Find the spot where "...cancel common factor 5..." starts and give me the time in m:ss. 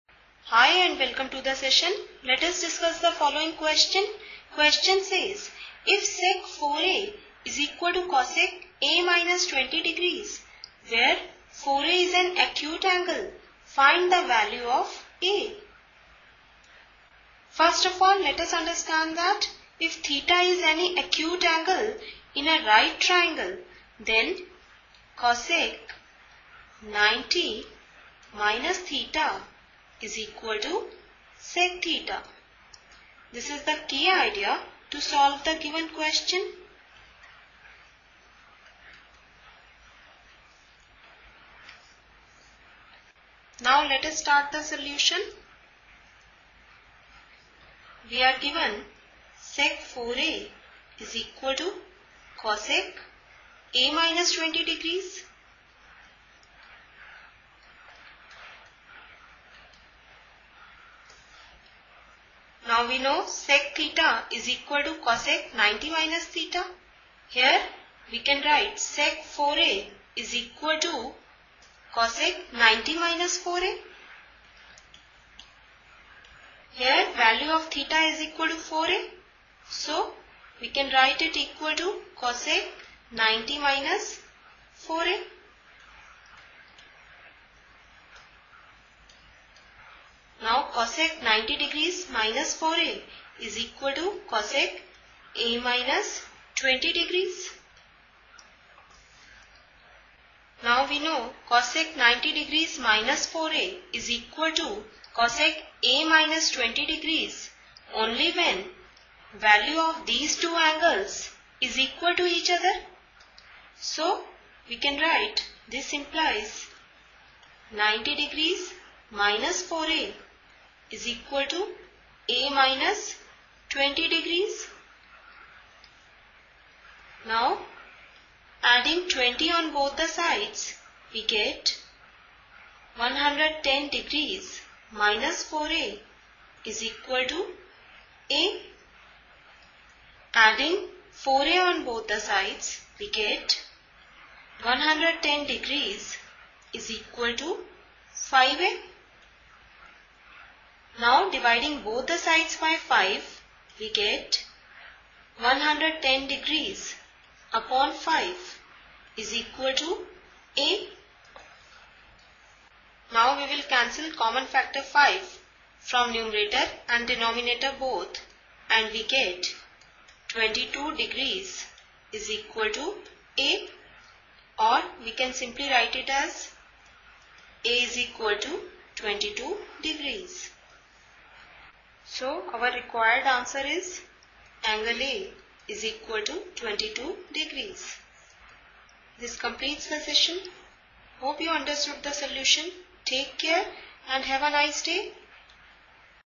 2:43.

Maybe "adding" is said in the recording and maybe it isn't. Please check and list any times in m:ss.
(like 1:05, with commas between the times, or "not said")
2:08, 2:20.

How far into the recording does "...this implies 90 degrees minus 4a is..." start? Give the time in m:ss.
1:55.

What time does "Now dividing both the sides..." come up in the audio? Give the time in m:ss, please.
2:30.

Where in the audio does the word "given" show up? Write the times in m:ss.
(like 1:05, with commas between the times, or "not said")
0:35, 0:48.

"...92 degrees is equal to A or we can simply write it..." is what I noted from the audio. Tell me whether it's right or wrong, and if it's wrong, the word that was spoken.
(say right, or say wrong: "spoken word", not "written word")
wrong: "22", not "92".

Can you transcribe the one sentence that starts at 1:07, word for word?
Here we can write sec 4a is equal to cosec 90 minus 4a.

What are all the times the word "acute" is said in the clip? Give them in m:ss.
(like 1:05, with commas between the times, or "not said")
0:12, 0:20.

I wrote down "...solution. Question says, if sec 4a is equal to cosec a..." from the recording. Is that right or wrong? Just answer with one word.
wrong.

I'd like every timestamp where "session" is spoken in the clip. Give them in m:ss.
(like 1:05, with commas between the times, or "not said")
0:01, 3:09.